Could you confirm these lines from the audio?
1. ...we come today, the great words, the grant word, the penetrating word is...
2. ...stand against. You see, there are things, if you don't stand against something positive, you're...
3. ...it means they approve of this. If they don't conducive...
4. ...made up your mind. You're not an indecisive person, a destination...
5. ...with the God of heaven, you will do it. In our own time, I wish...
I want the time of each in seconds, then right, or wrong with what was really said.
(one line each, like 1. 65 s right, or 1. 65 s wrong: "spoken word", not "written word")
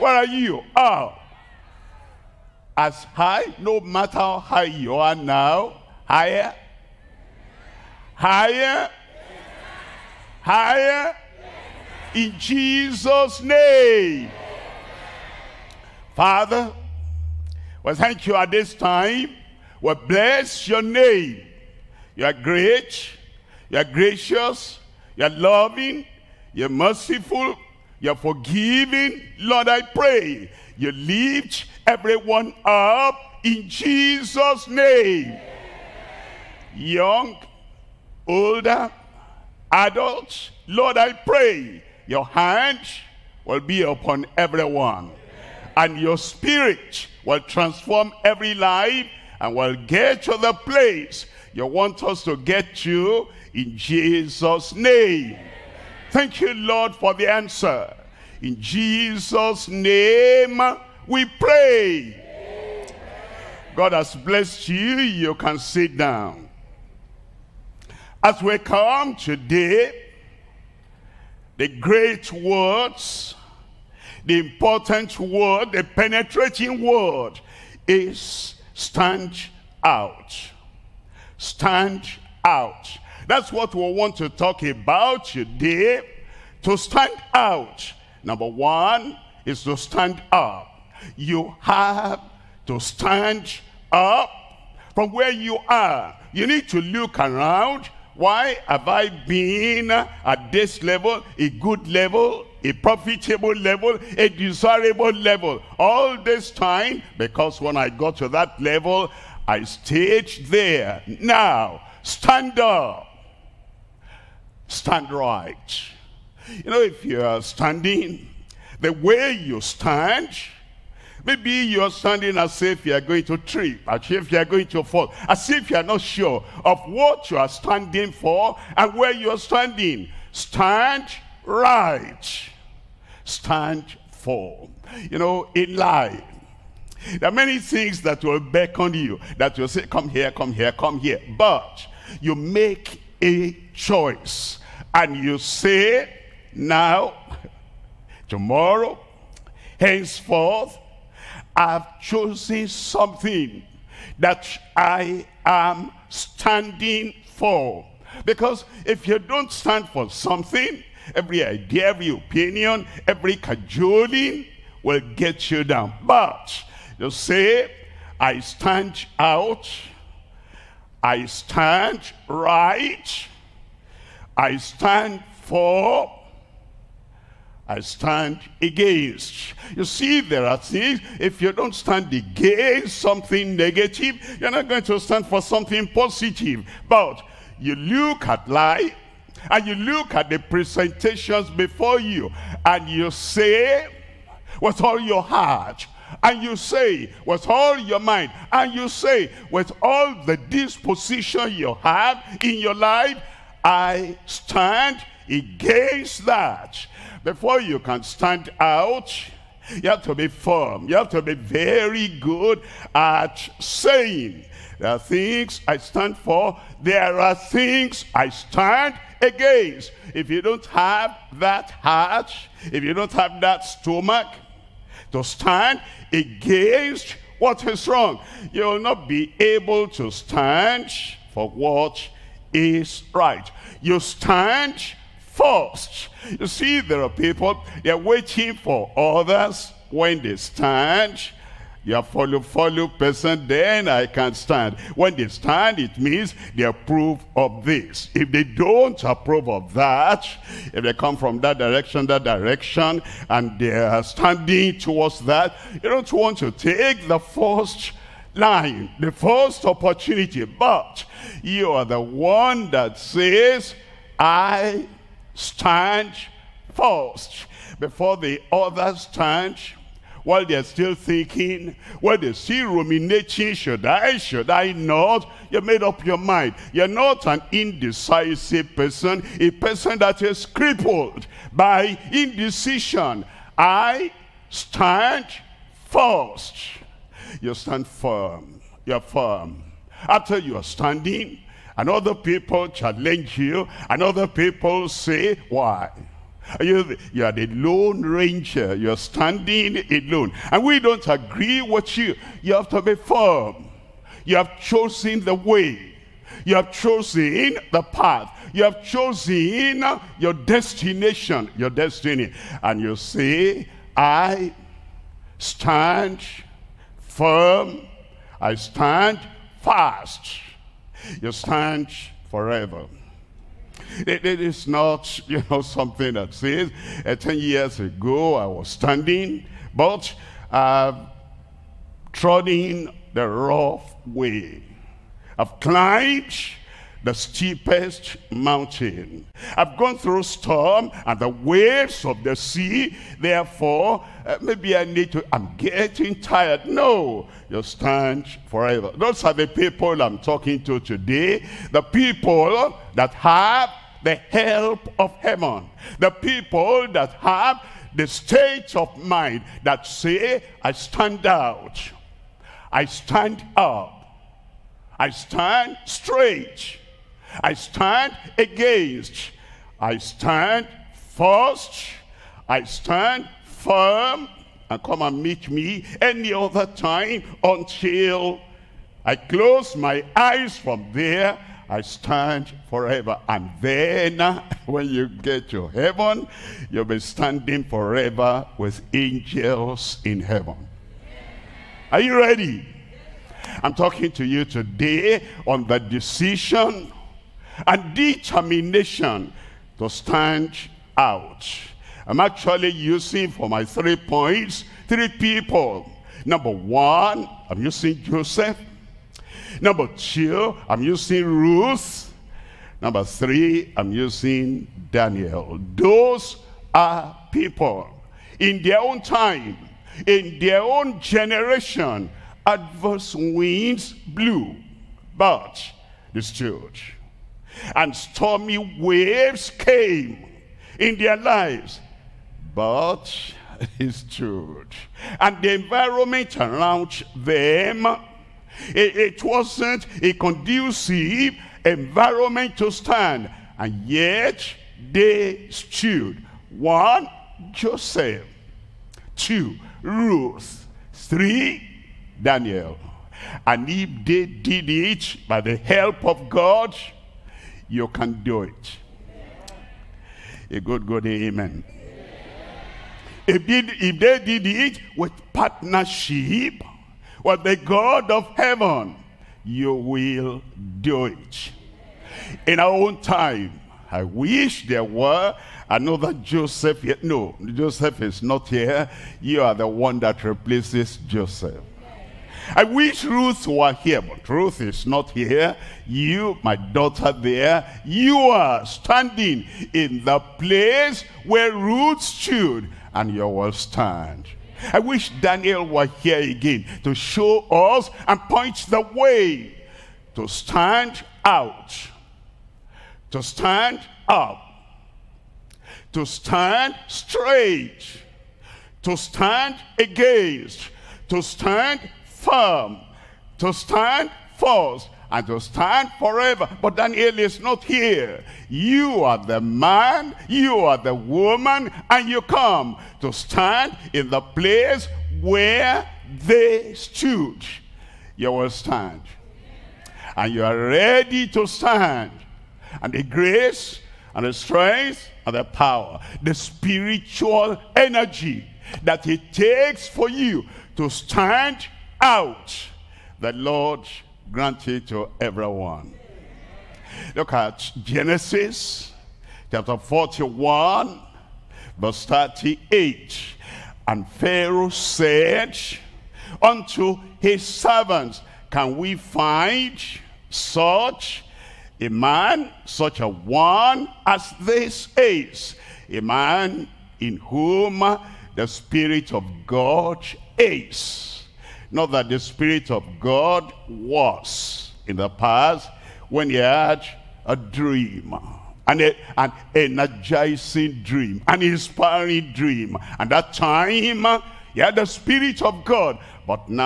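1. 68 s wrong: "important", not "grant"
2. 177 s wrong: "negative", not "positive"
3. 245 s wrong: "approve", not "conducive"
4. 275 s wrong: "person", not "destination"
5. 467 s right.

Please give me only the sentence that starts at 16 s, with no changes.
Father, well, thank you at this time.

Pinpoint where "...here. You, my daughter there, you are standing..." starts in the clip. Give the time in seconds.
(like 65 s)
485 s.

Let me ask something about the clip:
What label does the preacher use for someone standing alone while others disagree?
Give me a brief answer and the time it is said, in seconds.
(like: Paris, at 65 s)
Lone ranger, at 297 s.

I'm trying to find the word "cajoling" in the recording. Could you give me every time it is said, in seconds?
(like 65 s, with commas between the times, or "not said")
163 s.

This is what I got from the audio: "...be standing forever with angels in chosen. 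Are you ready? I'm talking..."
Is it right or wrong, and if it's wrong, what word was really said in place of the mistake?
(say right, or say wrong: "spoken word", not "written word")
wrong: "heaven", not "chosen".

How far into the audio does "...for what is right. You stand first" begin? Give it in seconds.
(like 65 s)
231 s.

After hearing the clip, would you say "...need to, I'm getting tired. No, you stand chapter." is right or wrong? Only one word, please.
wrong.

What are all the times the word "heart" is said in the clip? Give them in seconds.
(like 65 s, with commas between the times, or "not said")
195 s, 221 s.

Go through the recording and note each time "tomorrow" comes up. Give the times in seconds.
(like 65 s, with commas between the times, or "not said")
148 s.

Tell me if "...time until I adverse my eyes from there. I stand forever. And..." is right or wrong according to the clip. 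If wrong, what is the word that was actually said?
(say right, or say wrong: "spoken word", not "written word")
wrong: "close", not "adverse".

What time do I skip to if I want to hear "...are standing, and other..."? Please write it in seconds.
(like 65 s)
290 s.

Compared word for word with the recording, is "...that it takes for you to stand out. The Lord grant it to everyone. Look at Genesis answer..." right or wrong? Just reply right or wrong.
wrong.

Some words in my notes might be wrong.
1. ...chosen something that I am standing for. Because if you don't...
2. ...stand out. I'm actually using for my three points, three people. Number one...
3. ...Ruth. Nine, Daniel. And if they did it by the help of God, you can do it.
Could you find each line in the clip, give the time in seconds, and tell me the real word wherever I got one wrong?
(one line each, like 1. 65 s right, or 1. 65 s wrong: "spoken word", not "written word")
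1. 152 s right
2. 399 s right
3. 449 s wrong: "Three", not "Nine".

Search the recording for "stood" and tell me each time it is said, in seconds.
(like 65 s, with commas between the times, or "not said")
433 s, 445 s, 492 s, 526 s.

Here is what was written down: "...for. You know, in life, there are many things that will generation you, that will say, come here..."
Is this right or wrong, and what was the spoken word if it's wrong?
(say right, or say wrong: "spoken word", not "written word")
wrong: "beckon", not "generation".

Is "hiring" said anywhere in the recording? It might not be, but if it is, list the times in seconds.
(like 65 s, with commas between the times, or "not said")
not said.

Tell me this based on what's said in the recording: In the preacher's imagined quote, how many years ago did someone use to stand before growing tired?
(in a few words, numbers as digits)
10.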